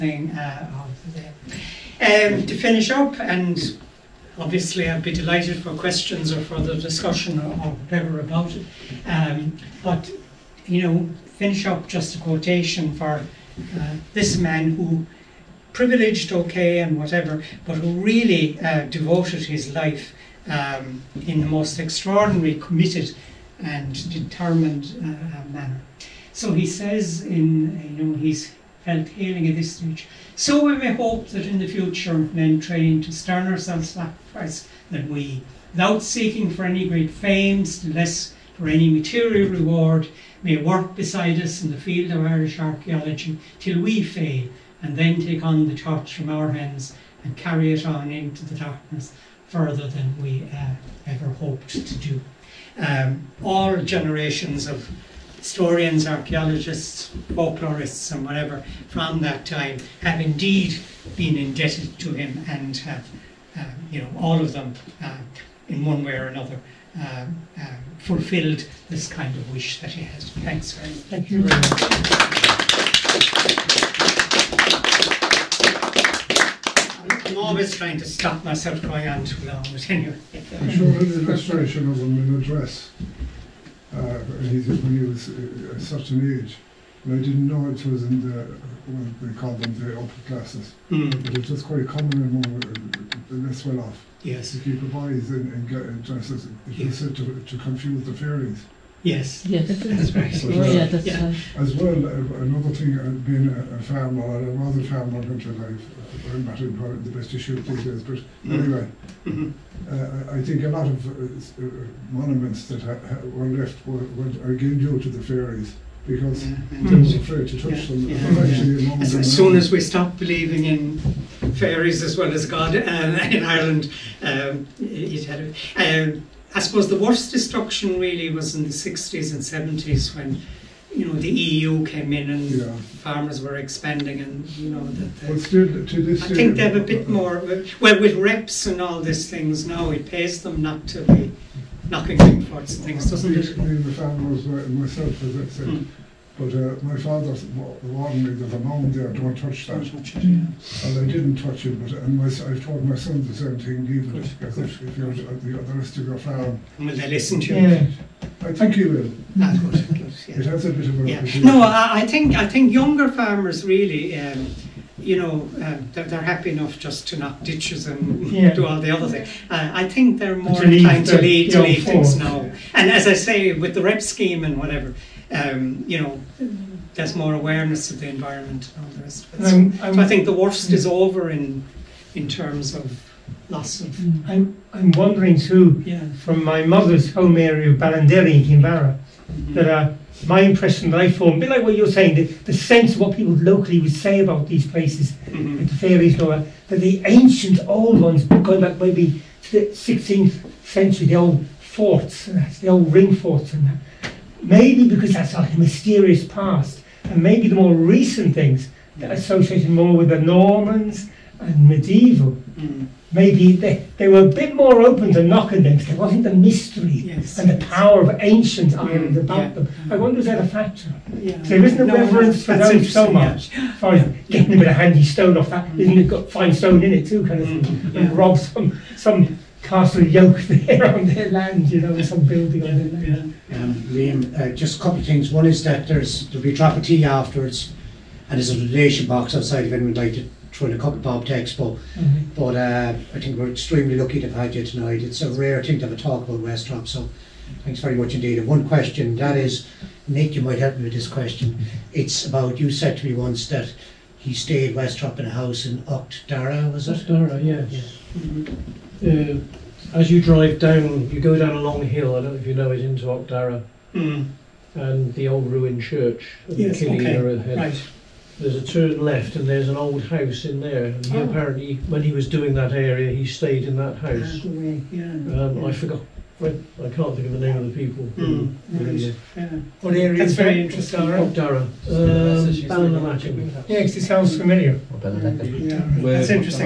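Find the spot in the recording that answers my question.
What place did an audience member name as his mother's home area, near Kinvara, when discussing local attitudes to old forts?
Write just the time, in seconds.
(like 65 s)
187 s.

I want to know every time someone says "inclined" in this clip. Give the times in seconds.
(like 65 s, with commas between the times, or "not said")
170 s.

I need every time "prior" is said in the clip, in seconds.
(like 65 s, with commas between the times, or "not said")
not said.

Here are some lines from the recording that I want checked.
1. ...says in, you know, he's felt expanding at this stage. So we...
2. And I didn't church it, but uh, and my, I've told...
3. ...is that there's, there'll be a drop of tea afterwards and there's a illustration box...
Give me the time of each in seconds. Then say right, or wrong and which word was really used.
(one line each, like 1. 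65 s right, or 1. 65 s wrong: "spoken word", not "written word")
1. 26 s wrong: "hailing", not "expanding"
2. 150 s wrong: "touch", not "church"
3. 235 s wrong: "donation", not "illustration".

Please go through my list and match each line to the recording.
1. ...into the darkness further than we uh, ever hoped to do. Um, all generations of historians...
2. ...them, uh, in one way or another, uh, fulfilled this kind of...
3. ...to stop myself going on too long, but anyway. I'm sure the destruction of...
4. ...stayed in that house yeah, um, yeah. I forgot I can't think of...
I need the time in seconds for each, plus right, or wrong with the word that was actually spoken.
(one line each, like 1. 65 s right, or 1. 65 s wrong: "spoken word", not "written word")
1. 48 s right
2. 64 s right
3. 77 s wrong: "illustration", not "destruction"
4. 273 s right.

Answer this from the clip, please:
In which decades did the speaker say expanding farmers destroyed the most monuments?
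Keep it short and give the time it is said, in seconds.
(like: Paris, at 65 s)
The 60s and 70s, at 128 s.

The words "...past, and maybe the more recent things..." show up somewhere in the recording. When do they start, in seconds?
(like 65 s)
206 s.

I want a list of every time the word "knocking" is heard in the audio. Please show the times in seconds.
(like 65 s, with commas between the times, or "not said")
141 s, 215 s.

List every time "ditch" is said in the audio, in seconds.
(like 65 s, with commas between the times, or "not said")
167 s.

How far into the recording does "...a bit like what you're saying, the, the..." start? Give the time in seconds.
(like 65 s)
191 s.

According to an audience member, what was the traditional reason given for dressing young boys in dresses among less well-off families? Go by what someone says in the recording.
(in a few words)
To confuse the fairies.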